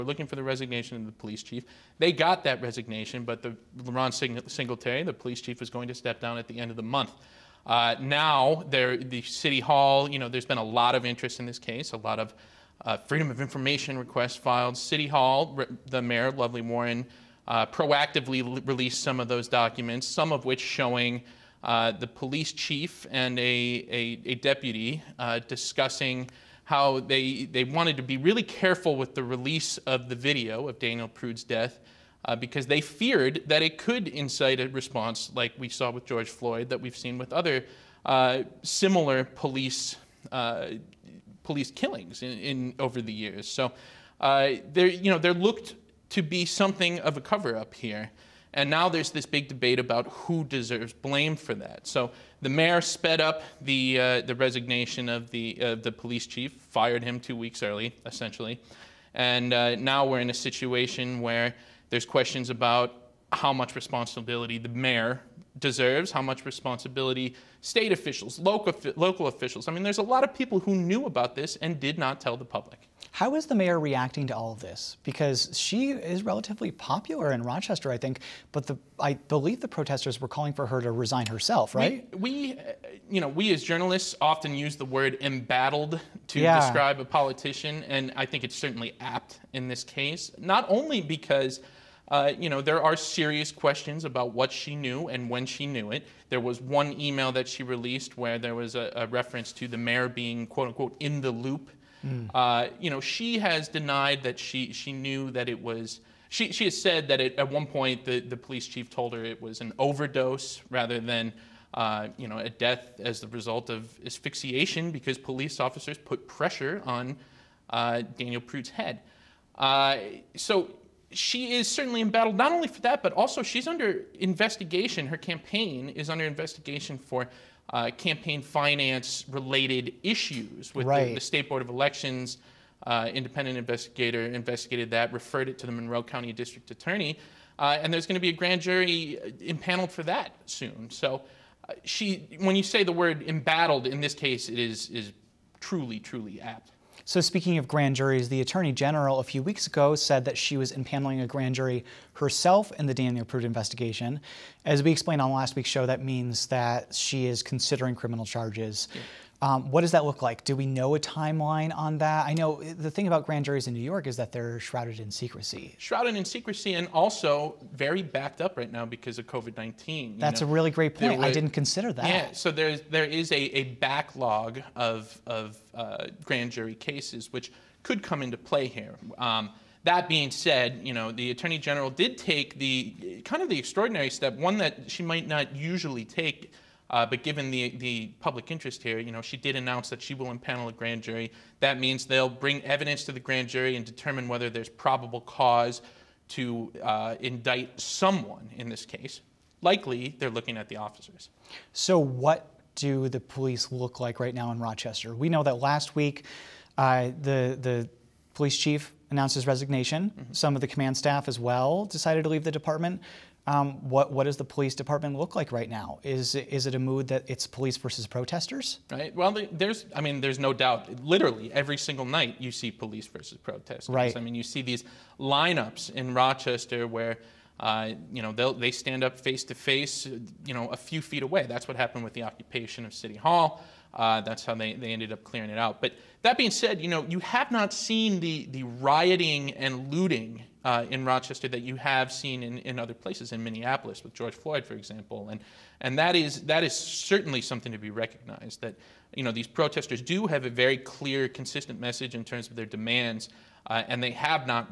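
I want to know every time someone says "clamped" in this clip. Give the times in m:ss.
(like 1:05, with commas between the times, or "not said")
not said.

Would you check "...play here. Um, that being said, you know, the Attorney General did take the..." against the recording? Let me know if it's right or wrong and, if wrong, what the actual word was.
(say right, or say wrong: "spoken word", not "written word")
right.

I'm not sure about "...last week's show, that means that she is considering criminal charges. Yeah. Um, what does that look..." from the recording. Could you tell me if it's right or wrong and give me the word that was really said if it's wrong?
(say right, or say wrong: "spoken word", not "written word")
right.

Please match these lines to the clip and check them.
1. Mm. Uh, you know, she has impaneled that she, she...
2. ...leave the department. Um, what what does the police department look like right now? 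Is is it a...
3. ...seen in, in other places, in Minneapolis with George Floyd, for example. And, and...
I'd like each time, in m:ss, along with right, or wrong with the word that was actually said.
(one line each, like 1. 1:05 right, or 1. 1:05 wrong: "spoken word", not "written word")
1. 1:42 wrong: "denied", not "impaneled"
2. 3:32 right
3. 4:02 right.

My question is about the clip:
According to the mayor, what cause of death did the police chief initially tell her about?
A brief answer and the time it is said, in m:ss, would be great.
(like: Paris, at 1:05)
An overdose, at 1:49.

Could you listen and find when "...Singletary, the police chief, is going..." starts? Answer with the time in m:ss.
0:04.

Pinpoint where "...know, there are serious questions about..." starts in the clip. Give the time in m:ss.
1:32.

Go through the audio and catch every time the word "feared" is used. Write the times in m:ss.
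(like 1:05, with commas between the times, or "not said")
0:32.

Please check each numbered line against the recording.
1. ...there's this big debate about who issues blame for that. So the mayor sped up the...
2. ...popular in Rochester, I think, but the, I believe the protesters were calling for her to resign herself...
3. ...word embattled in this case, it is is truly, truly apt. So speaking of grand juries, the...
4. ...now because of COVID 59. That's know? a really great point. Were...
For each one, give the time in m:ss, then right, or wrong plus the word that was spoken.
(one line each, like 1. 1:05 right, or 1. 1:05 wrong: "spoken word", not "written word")
1. 0:48 wrong: "deserves", not "issues"
2. 1:16 right
3. 2:22 right
4. 2:48 wrong: "19", not "59".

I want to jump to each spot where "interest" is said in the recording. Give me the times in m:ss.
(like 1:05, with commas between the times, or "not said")
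0:11, 3:08.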